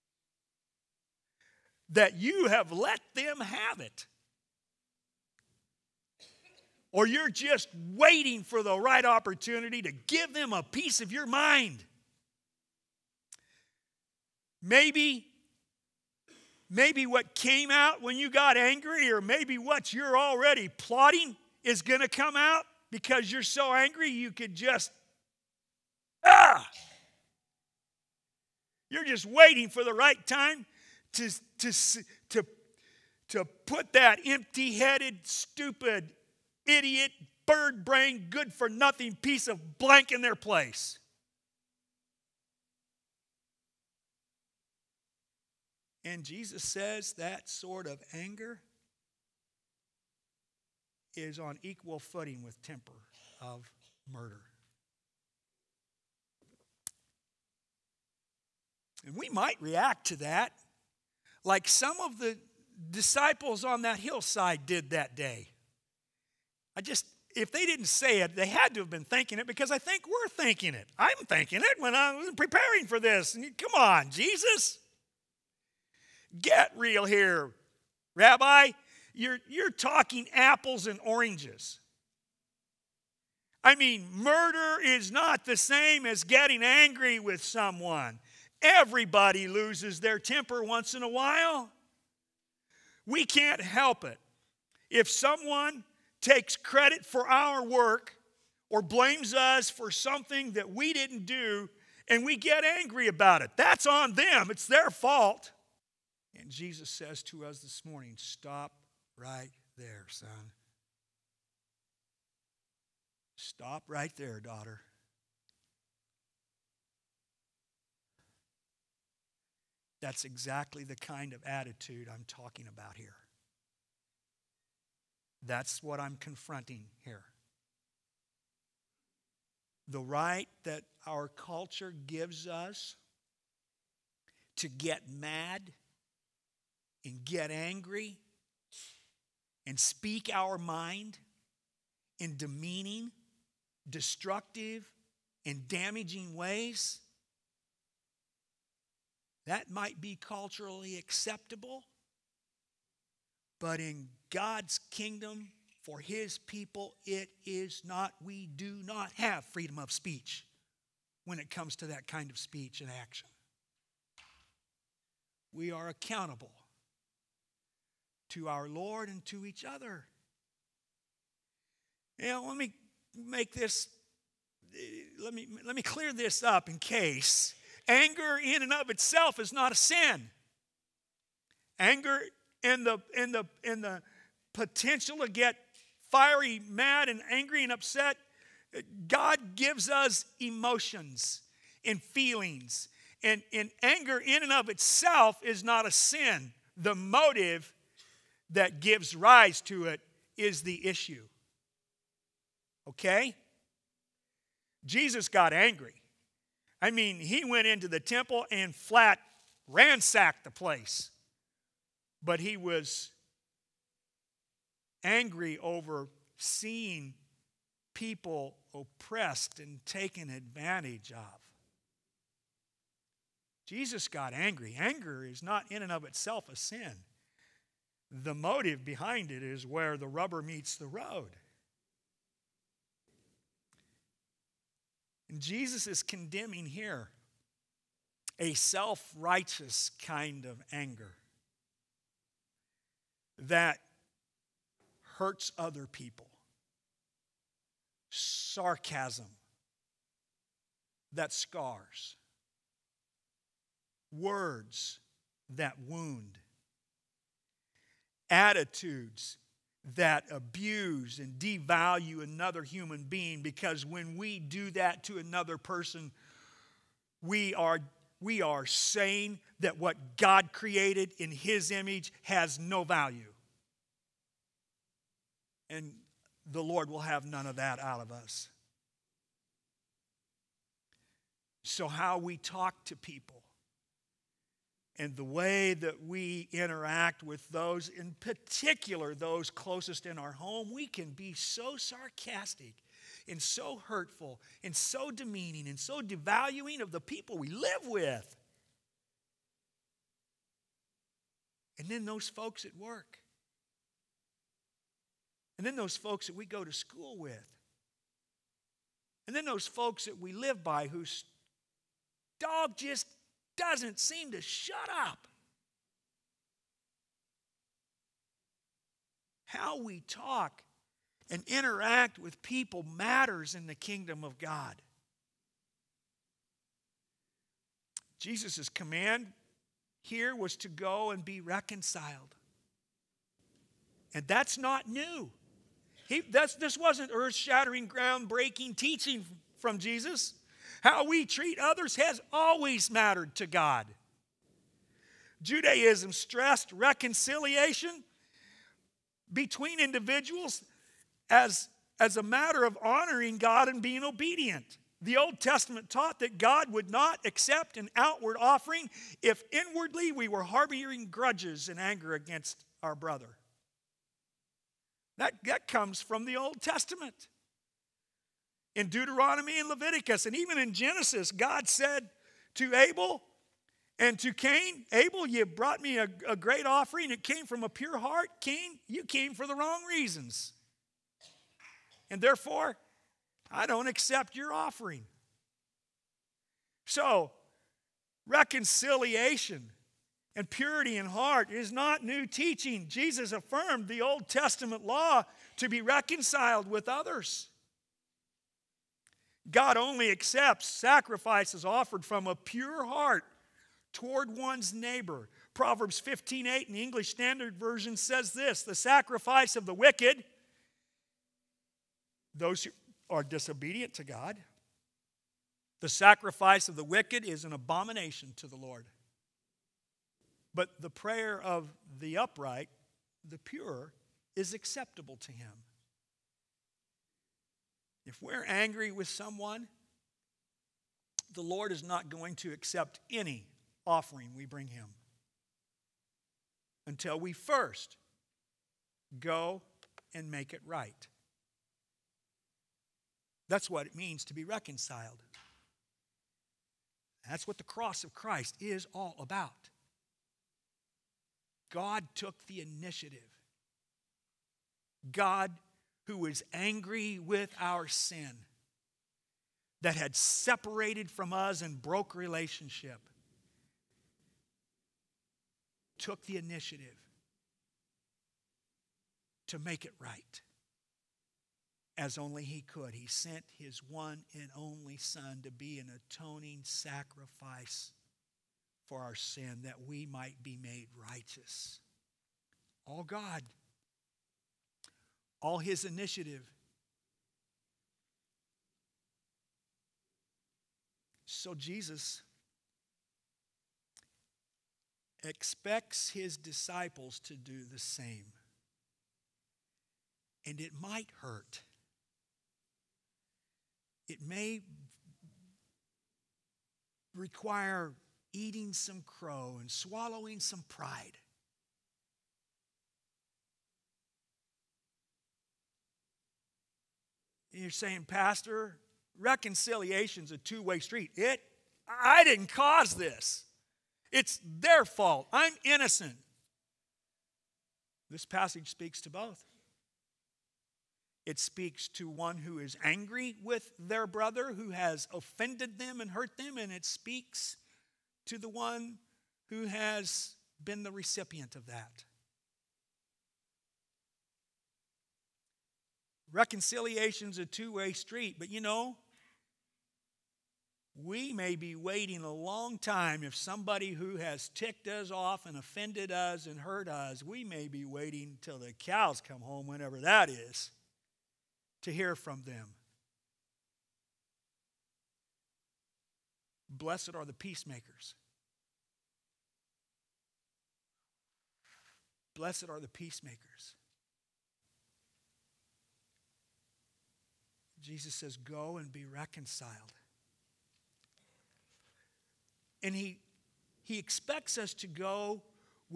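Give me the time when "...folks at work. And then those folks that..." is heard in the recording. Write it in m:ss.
5:02.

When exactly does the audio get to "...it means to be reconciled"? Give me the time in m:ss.
7:23.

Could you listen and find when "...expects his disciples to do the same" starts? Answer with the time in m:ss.
8:15.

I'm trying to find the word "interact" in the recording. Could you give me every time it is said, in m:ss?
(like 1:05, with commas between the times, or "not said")
4:46, 5:21.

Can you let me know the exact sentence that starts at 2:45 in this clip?
We are accountable to our Lord and to each other.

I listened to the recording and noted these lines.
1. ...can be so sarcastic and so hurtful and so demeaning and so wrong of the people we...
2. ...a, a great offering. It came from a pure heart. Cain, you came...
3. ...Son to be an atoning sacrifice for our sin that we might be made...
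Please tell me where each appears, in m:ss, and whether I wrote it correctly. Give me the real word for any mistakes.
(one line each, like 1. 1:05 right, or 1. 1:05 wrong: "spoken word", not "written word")
1. 4:50 wrong: "devaluing", not "wrong"
2. 6:15 right
3. 7:54 right.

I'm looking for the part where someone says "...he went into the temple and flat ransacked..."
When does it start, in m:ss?
3:27.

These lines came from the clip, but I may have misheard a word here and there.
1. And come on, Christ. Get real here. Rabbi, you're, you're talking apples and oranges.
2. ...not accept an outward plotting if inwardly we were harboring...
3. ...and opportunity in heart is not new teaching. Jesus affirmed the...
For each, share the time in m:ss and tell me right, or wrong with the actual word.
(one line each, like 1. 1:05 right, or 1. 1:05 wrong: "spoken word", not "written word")
1. 1:13 wrong: "Jesus", not "Christ"
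2. 5:56 wrong: "offering", not "plotting"
3. 6:30 wrong: "purity", not "opportunity".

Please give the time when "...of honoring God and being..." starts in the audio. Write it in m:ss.
5:52.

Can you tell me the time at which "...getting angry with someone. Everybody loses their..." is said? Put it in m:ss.
1:26.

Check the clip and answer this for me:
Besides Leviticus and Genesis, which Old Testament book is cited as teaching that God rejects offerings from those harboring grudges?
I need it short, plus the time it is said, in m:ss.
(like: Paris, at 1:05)
Deuteronomy, at 6:08.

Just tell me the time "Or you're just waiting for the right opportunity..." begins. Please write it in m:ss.
0:06.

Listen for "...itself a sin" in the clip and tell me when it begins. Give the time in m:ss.
3:46.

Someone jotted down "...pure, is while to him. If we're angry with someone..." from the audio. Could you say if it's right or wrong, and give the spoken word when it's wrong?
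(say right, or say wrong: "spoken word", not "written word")
wrong: "acceptable", not "while".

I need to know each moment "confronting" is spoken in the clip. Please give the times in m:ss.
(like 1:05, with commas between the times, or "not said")
2:06.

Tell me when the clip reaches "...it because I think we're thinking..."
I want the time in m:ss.
1:09.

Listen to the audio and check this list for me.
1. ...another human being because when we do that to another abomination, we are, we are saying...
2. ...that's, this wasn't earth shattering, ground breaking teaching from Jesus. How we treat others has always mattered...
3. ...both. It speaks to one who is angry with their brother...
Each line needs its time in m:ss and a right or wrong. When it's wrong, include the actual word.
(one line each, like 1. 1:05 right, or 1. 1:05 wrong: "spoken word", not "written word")
1. 4:22 wrong: "person", not "abomination"
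2. 5:36 right
3. 8:49 right.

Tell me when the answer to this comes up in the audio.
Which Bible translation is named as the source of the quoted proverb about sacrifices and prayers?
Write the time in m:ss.
6:46.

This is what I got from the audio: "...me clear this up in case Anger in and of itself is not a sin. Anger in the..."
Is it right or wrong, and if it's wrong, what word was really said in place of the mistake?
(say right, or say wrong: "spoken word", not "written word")
right.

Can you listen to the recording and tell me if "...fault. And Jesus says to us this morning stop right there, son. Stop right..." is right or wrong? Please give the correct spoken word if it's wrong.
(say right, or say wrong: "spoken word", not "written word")
right.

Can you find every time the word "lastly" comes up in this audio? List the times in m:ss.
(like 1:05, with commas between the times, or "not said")
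not said.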